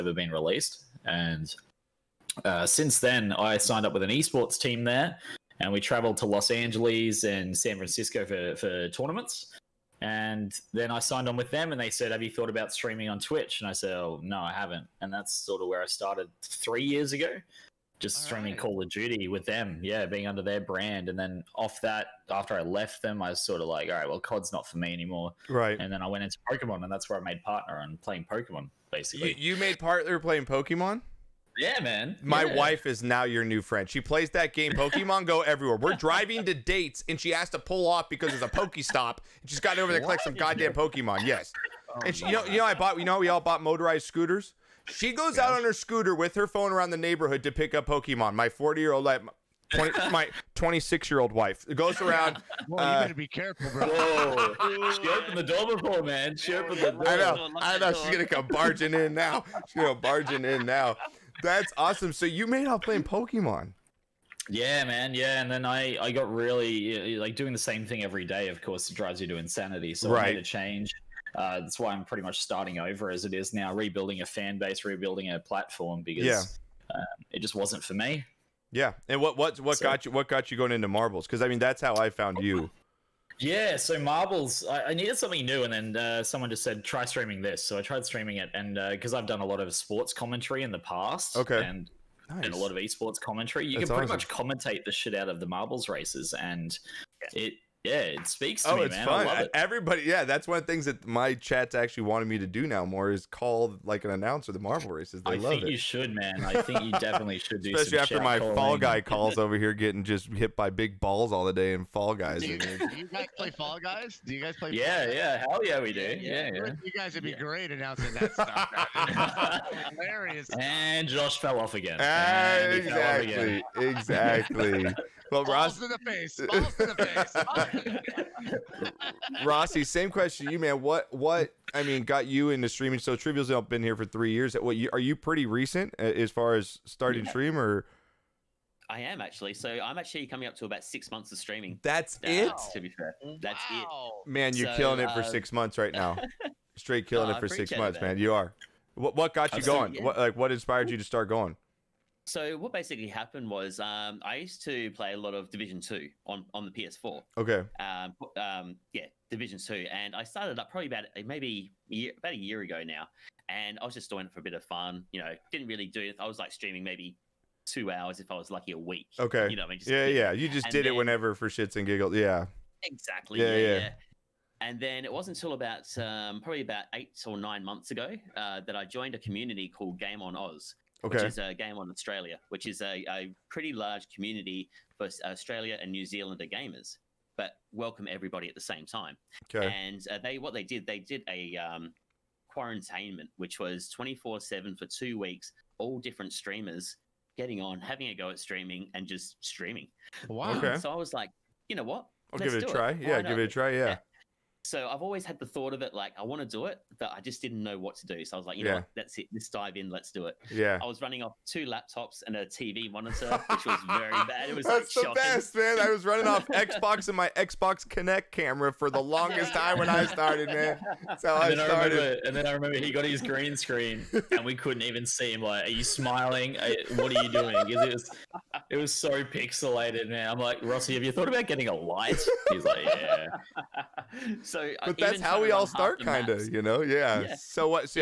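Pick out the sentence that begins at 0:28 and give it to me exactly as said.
Basically, you, you made partner playing Pokemon.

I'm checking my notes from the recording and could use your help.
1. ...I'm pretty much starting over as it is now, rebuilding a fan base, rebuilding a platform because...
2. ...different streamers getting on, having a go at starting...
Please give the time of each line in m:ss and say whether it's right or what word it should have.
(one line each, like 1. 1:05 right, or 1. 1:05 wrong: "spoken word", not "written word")
1. 1:11 right
2. 3:15 wrong: "streaming", not "starting".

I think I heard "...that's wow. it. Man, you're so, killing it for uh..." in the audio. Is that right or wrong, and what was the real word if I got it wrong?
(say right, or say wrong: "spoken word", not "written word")
right.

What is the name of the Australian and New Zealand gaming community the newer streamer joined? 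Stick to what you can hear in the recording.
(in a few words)
Game on Oz.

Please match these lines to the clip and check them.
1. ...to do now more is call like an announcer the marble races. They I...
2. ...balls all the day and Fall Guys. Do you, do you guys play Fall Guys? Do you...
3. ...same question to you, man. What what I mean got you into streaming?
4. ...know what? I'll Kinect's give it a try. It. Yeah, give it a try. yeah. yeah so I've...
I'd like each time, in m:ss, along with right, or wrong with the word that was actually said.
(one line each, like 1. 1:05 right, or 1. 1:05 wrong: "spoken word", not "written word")
1. 1:42 right
2. 1:51 right
3. 2:09 right
4. 3:21 wrong: "Let", not "Kinect".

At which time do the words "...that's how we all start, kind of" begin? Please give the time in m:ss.
3:54.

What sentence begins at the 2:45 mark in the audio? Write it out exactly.
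You know, didn't really do it.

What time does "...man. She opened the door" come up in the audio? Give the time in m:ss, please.
0:56.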